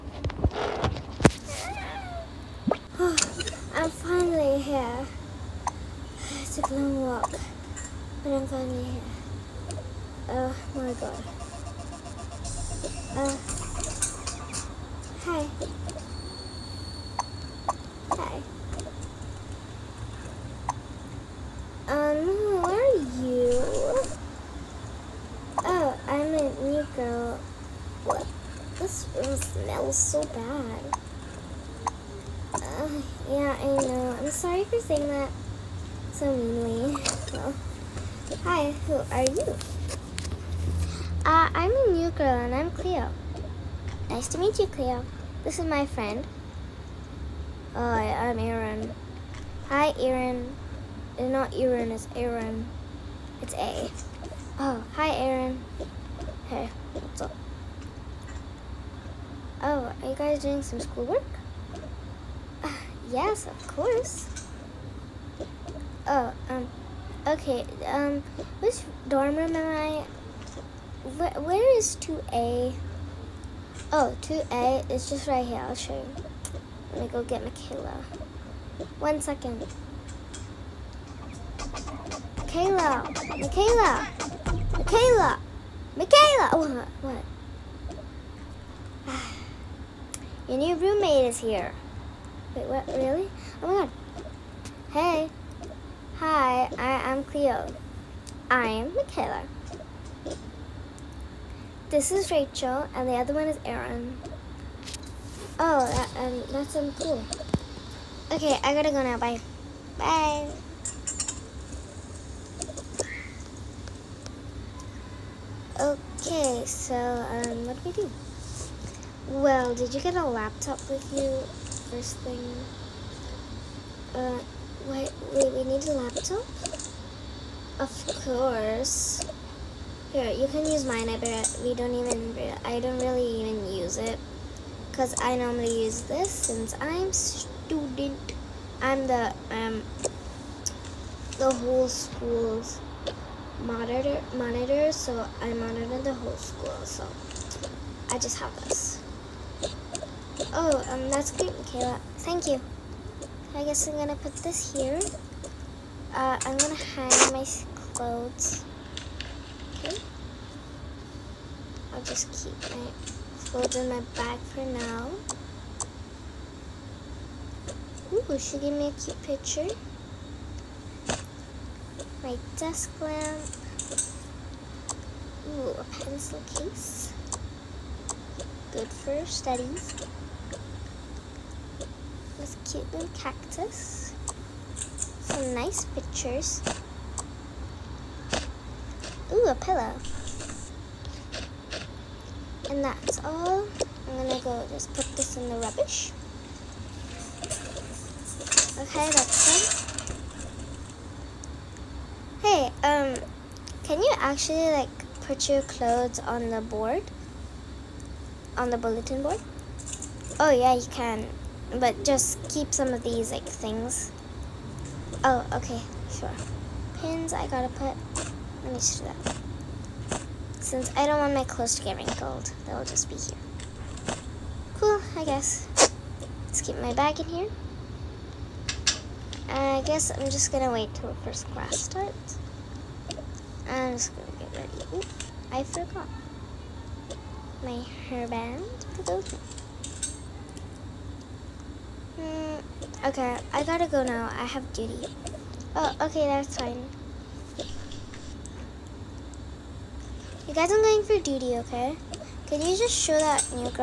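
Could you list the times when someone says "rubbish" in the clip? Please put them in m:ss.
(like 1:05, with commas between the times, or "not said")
3:15.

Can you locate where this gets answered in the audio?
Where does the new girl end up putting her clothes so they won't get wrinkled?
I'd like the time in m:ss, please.
3:28.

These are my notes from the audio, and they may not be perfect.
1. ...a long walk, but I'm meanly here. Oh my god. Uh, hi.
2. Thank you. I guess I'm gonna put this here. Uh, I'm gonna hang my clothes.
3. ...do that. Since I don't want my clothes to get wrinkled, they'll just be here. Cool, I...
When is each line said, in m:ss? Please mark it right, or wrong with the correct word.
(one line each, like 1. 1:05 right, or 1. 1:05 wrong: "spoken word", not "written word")
1. 0:06 wrong: "finally", not "meanly"
2. 2:32 right
3. 3:39 right.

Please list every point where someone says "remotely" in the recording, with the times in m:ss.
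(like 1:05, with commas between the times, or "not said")
not said.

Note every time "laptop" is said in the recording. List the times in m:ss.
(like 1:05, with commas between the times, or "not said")
2:00, 2:05.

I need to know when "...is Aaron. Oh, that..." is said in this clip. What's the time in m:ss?
1:43.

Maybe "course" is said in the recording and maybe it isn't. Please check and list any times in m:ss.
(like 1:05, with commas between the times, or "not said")
1:03, 2:08.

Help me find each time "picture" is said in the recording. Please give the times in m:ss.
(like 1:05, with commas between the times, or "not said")
2:49, 3:05.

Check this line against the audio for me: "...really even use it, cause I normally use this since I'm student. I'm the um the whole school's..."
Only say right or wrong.
right.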